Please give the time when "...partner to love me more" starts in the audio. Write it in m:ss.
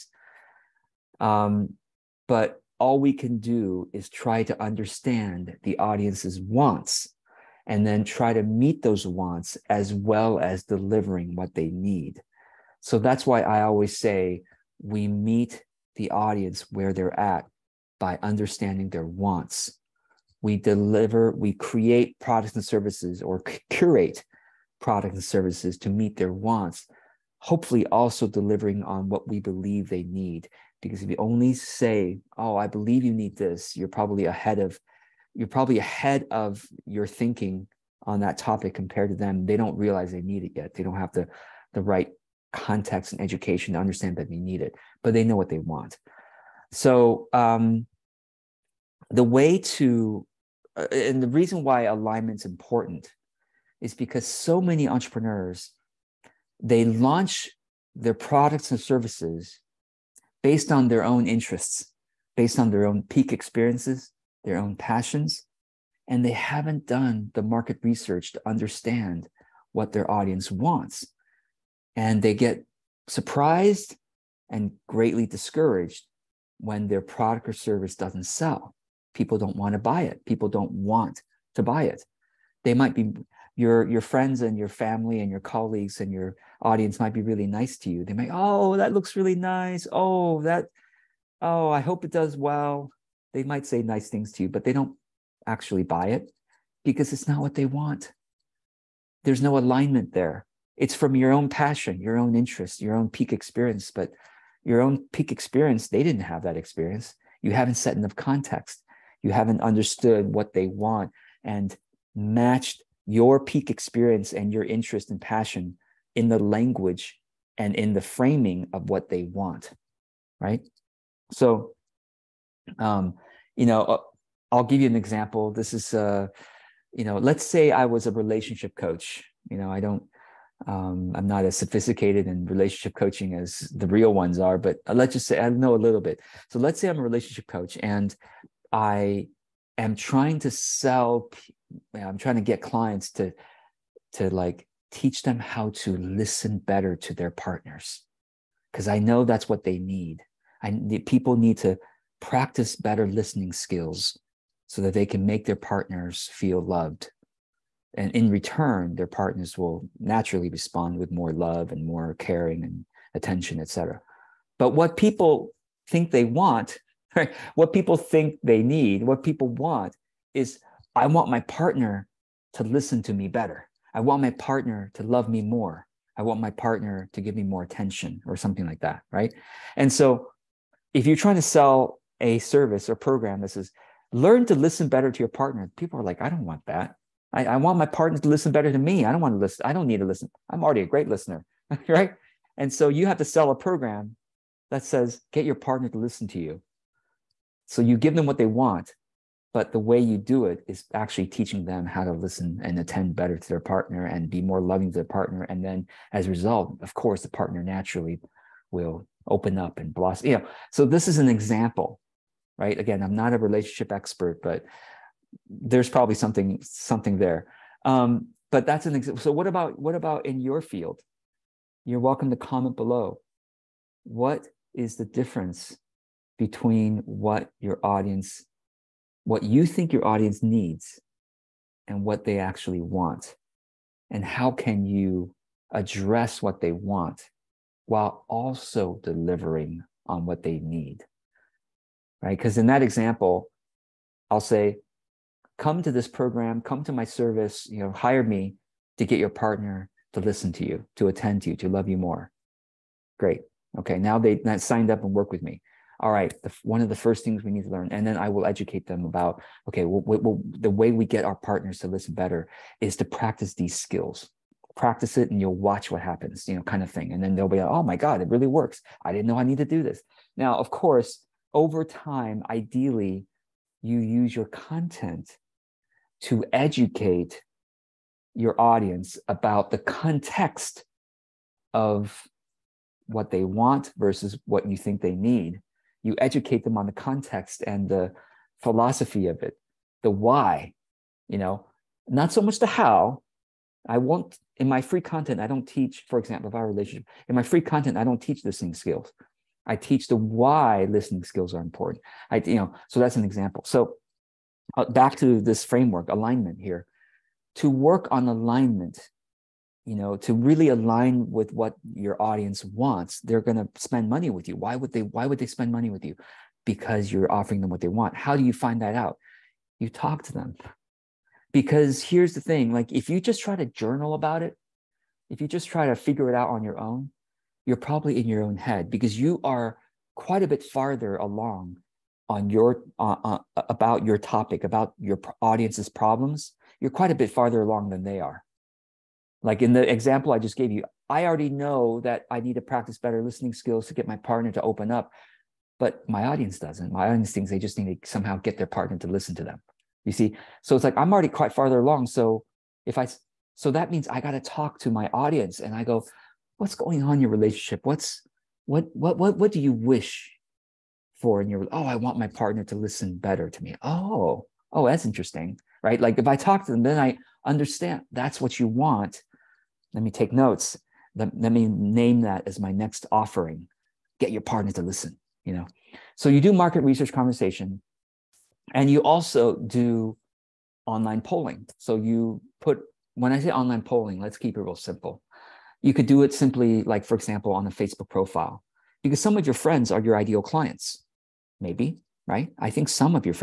2:54.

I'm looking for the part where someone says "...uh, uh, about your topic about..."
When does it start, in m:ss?
5:32.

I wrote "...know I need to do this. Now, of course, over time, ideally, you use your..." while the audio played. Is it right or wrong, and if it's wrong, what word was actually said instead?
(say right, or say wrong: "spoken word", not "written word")
right.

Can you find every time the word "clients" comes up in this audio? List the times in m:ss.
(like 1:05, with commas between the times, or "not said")
2:22, 6:30.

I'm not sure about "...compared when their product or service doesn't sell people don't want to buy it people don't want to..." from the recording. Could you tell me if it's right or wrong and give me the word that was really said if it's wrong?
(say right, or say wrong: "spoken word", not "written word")
wrong: "discouraged", not "compared".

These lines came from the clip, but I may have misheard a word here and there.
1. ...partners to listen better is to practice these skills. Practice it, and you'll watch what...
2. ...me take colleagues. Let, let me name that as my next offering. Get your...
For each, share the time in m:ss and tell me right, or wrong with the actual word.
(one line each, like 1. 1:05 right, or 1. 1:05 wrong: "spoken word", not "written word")
1. 4:21 right
2. 6:10 wrong: "notes", not "colleagues".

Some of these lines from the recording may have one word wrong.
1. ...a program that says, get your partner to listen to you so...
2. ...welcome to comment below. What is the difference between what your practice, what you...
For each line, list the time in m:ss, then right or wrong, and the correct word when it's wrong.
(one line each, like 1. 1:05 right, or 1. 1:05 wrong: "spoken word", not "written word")
1. 3:13 right
2. 3:42 wrong: "audience", not "practice".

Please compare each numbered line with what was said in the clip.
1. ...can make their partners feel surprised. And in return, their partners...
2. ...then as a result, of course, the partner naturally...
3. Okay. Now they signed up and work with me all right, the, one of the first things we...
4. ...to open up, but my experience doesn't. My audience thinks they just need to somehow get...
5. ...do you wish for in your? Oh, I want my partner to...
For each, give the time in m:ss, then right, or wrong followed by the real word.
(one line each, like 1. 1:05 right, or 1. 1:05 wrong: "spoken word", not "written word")
1. 2:35 wrong: "loved", not "surprised"
2. 3:25 right
3. 4:13 right
4. 5:44 wrong: "audience", not "experience"
5. 5:59 right.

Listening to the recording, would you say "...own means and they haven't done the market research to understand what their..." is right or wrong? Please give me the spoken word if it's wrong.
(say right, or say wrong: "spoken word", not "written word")
wrong: "passions", not "means".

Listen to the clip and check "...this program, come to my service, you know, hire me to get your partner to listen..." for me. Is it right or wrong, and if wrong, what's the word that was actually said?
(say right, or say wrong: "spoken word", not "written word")
right.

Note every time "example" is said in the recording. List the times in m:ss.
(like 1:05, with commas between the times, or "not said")
2:04, 3:31, 3:38, 4:02, 4:56, 5:03, 5:39, 6:27.